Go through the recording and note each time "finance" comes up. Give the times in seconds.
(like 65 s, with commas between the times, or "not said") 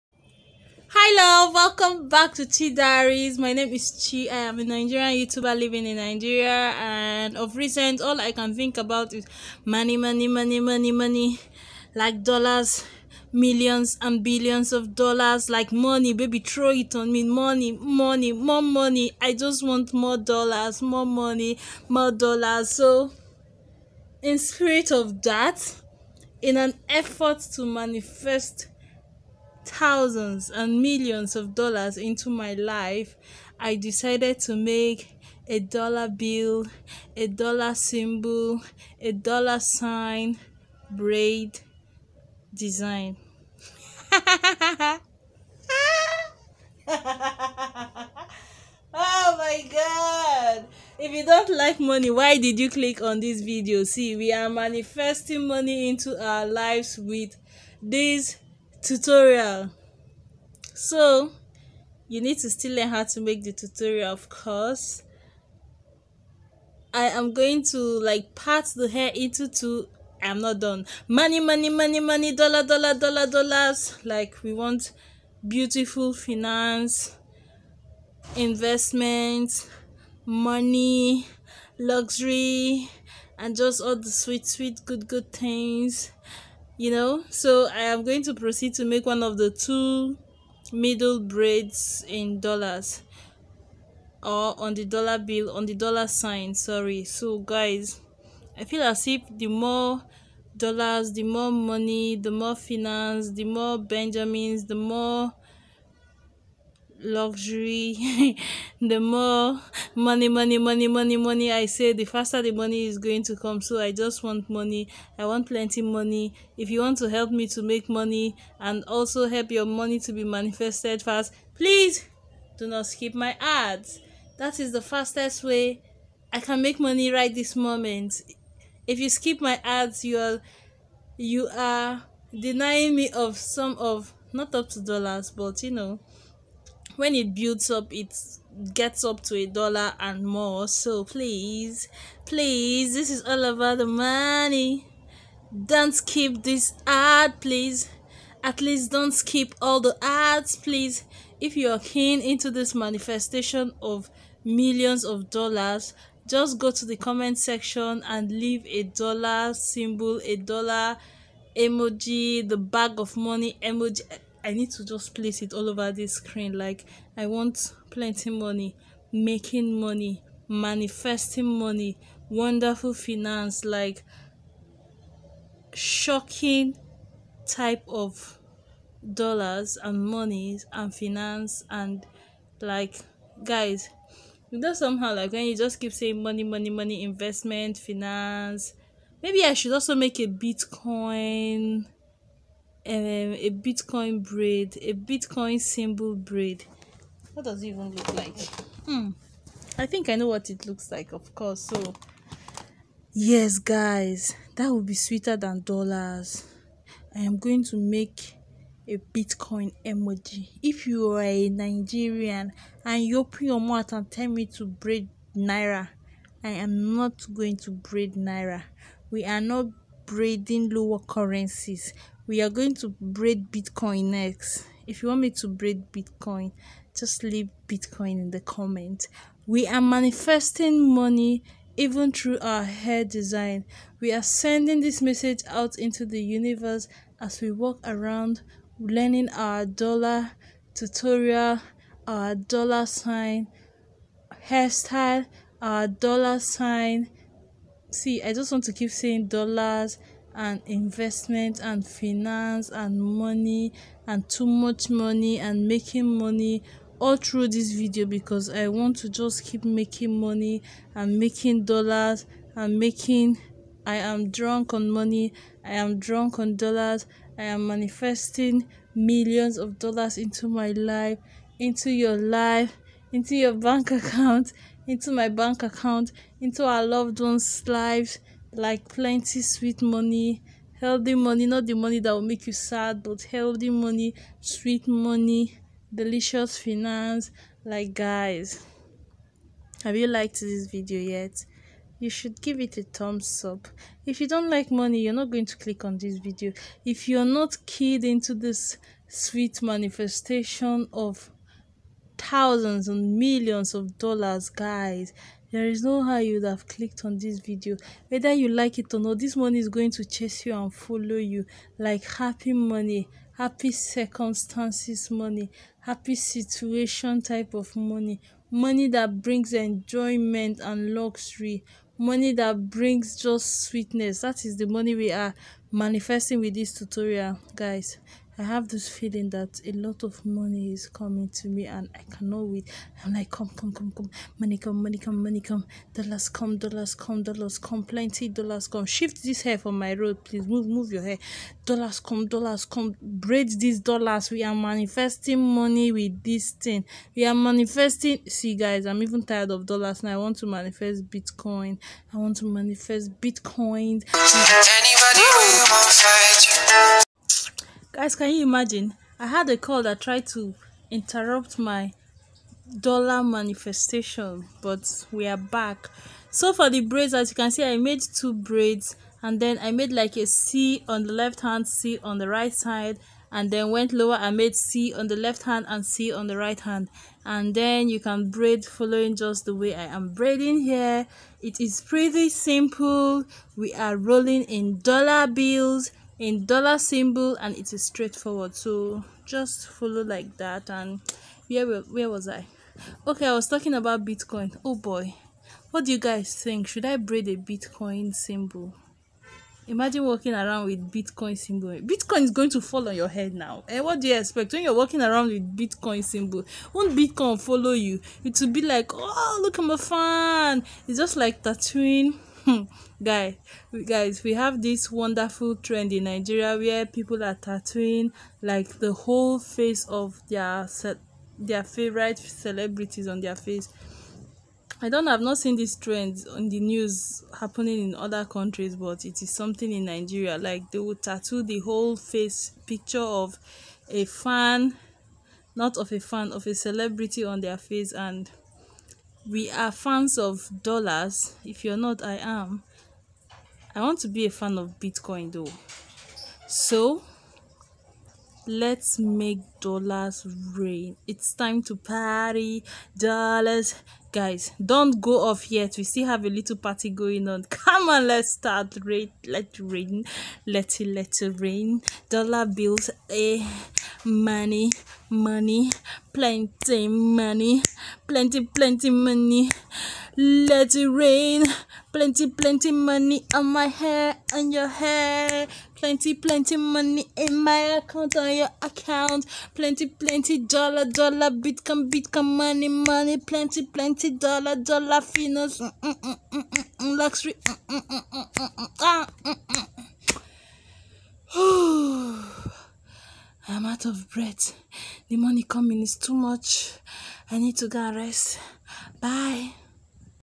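76 s, 102 s, 172 s, 180 s, 187 s, 251 s, 286 s, 484 s.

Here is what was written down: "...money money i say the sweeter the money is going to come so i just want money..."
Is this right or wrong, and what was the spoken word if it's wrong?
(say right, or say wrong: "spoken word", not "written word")
wrong: "faster", not "sweeter".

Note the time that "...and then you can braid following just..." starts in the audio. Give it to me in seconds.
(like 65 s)
377 s.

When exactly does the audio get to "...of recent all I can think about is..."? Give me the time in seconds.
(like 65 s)
7 s.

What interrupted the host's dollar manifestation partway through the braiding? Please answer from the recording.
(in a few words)
a call.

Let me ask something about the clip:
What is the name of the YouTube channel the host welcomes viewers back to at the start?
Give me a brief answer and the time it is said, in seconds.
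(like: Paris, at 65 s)
Chy Diaries, at 2 s.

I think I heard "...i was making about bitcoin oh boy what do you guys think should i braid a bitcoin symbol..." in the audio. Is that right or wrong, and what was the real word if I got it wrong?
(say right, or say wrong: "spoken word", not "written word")
wrong: "talking", not "making".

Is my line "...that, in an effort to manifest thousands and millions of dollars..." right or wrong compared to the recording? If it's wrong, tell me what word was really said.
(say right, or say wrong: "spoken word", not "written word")
right.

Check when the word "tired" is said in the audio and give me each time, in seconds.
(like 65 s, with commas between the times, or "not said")
349 s.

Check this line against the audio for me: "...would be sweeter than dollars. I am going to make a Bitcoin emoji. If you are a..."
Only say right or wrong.
right.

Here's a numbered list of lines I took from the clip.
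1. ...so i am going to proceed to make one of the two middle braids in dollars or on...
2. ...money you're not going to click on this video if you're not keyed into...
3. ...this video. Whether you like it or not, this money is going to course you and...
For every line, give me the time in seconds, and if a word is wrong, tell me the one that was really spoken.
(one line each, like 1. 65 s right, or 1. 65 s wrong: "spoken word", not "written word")
1. 87 s right
2. 294 s right
3. 307 s wrong: "chase", not "course".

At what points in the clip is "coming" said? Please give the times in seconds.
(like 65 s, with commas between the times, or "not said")
330 s, 495 s.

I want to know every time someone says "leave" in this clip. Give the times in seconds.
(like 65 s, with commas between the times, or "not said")
158 s, 227 s.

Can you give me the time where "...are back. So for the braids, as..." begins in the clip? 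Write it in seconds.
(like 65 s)
365 s.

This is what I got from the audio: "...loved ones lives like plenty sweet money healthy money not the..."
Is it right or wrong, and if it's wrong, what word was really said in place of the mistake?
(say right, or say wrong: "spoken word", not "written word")
right.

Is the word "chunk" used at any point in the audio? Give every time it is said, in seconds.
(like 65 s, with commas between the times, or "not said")
not said.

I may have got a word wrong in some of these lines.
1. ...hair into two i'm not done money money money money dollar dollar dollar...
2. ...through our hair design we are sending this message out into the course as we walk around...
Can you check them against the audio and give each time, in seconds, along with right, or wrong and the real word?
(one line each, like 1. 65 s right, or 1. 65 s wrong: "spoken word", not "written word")
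1. 68 s right
2. 232 s wrong: "universe", not "course".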